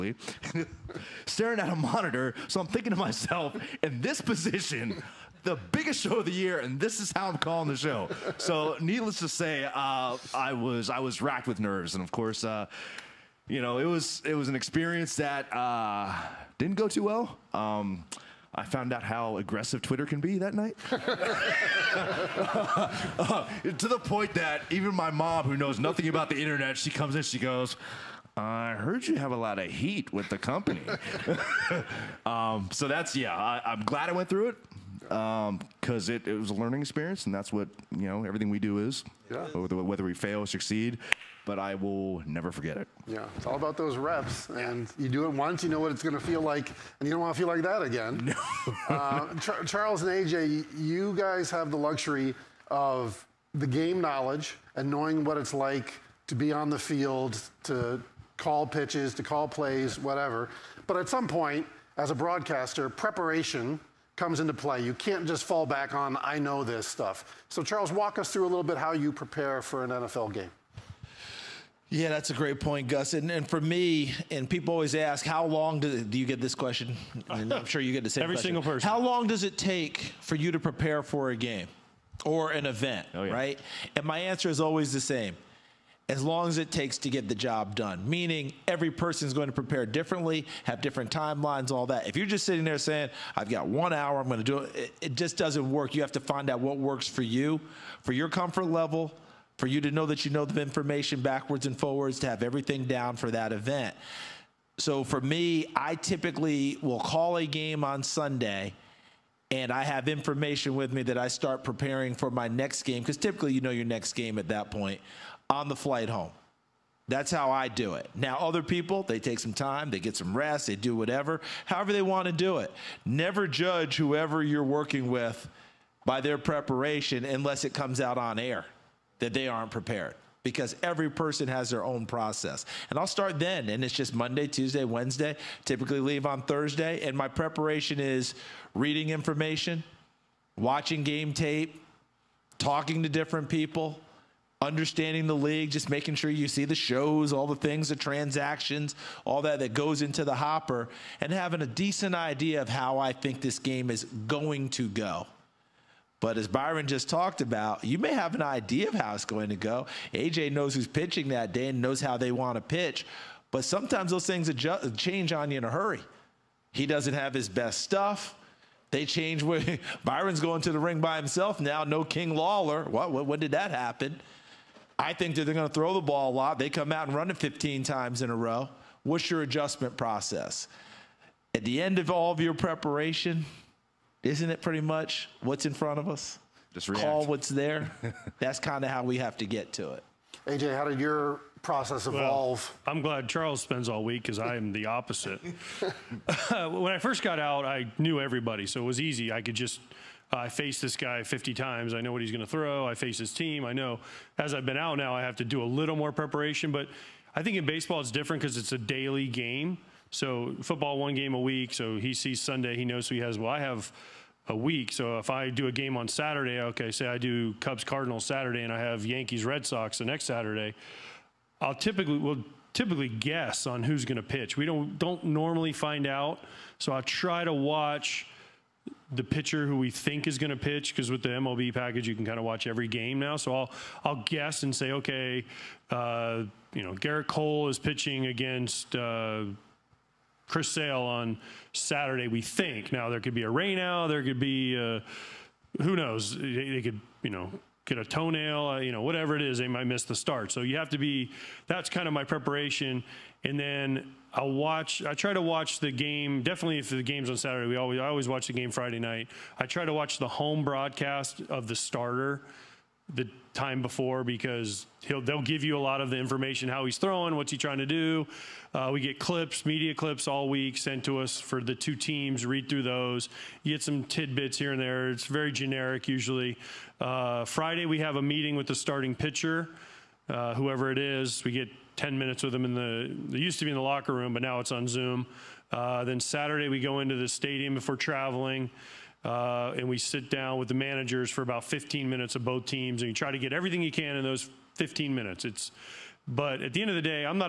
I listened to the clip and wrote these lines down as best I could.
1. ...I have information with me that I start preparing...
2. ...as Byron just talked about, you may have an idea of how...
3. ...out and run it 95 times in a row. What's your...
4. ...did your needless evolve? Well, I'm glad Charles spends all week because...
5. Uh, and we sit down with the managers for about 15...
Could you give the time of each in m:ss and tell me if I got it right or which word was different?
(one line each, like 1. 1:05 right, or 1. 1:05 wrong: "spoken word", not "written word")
1. 1:49 right
2. 2:36 right
3. 2:56 wrong: "15", not "95"
4. 3:10 wrong: "process", not "needless"
5. 4:49 right.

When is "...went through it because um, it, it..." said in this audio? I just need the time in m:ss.
0:34.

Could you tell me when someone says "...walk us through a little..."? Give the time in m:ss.
1:07.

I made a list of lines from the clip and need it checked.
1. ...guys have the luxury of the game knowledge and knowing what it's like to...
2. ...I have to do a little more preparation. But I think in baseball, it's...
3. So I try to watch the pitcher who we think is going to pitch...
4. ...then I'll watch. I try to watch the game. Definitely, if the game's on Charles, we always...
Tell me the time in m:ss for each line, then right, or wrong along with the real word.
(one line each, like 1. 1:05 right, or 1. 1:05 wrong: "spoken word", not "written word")
1. 0:51 right
2. 3:25 right
3. 3:46 right
4. 4:13 wrong: "Saturday", not "Charles".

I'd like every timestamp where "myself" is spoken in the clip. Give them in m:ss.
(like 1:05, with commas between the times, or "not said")
0:02.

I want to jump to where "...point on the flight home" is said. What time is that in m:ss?
1:54.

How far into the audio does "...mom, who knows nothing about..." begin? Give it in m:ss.
0:25.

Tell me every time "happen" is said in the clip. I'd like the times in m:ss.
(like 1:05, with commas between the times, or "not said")
2:53.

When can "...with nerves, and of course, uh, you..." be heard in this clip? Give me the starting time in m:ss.
0:11.